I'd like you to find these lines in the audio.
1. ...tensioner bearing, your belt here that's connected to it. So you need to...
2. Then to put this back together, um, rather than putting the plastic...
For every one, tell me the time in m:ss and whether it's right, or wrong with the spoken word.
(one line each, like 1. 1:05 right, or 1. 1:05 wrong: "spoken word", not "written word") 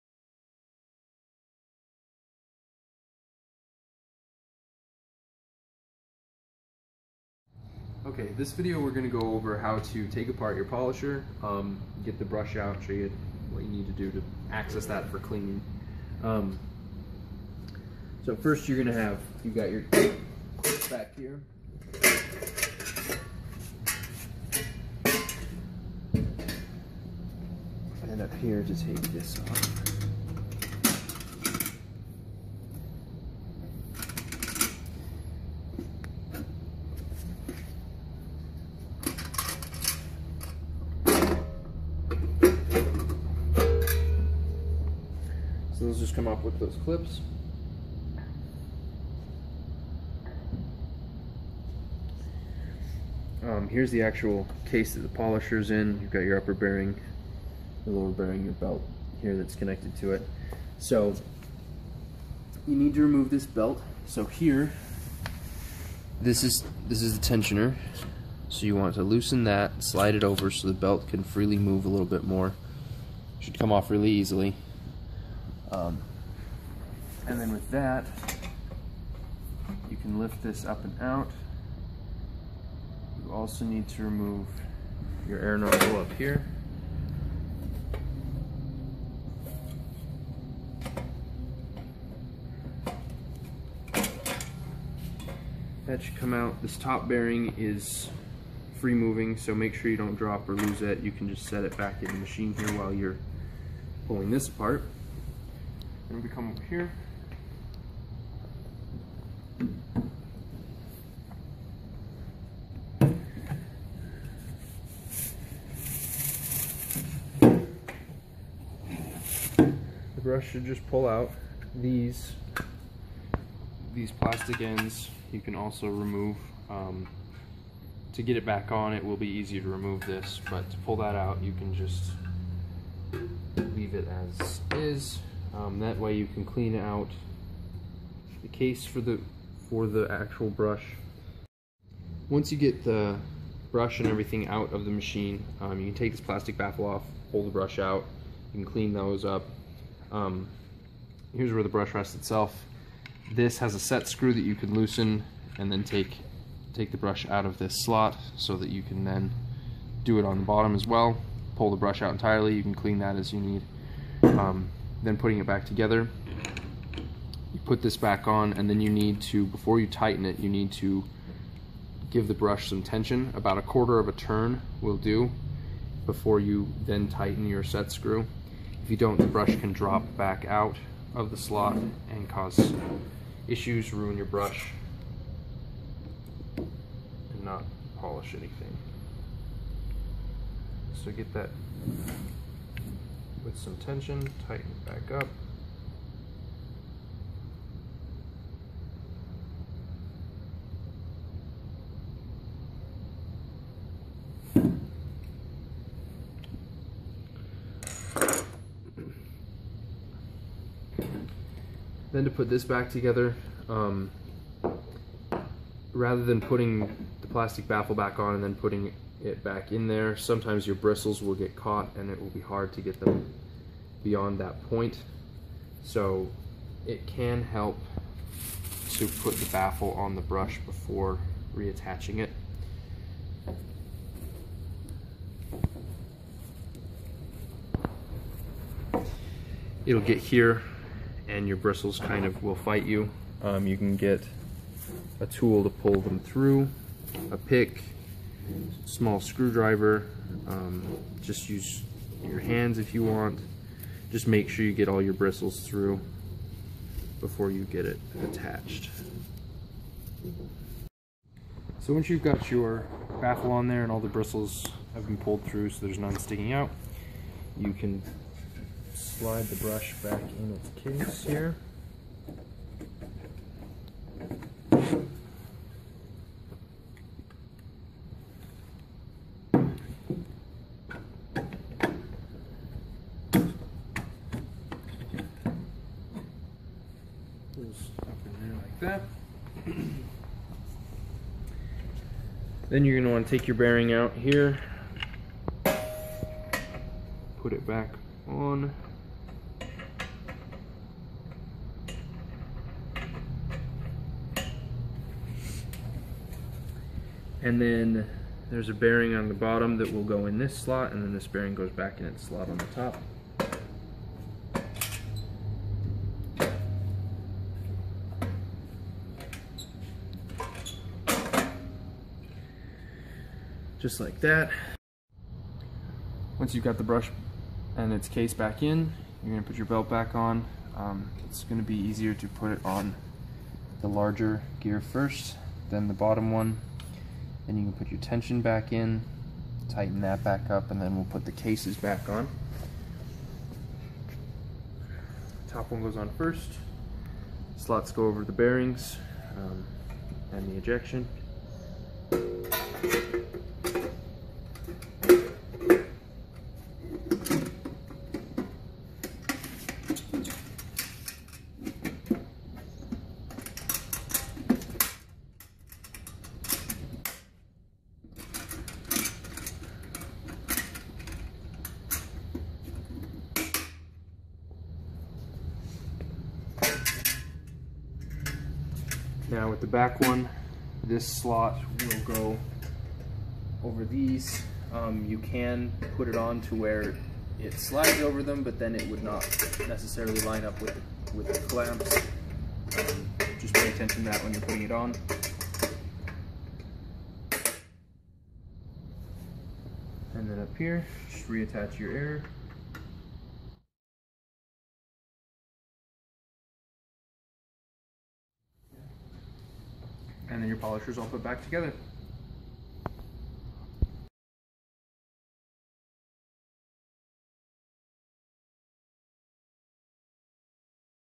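1. 0:57 wrong: "lower", not "tensioner"
2. 3:32 right.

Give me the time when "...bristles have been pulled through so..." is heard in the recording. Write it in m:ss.
4:24.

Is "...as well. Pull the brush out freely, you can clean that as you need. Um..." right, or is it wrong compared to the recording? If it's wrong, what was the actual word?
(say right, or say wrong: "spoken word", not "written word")
wrong: "entirely", not "freely".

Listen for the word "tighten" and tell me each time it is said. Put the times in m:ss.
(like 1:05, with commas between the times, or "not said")
2:49, 2:57, 3:14, 5:39.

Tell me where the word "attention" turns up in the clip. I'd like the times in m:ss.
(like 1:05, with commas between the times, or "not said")
6:33.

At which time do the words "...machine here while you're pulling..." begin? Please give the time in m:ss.
1:42.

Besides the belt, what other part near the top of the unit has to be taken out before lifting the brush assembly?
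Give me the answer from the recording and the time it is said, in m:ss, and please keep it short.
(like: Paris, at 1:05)
air nozzle, at 1:25.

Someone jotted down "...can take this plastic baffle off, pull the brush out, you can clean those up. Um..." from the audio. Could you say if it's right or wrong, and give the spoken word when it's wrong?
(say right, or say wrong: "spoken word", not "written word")
right.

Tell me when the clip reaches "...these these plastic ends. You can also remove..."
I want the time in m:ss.
2:01.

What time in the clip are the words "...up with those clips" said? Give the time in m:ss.
0:46.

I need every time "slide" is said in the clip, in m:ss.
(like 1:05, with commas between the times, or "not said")
1:09, 4:28, 6:27.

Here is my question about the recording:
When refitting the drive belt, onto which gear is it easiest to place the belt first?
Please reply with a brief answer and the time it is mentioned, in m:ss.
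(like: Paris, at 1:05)
the larger gear, at 5:33.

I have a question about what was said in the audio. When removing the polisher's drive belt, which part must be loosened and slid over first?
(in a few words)
the tensioner.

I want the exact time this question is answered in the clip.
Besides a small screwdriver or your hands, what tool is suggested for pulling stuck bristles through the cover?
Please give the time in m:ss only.
4:07.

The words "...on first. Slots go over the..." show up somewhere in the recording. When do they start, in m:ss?
5:45.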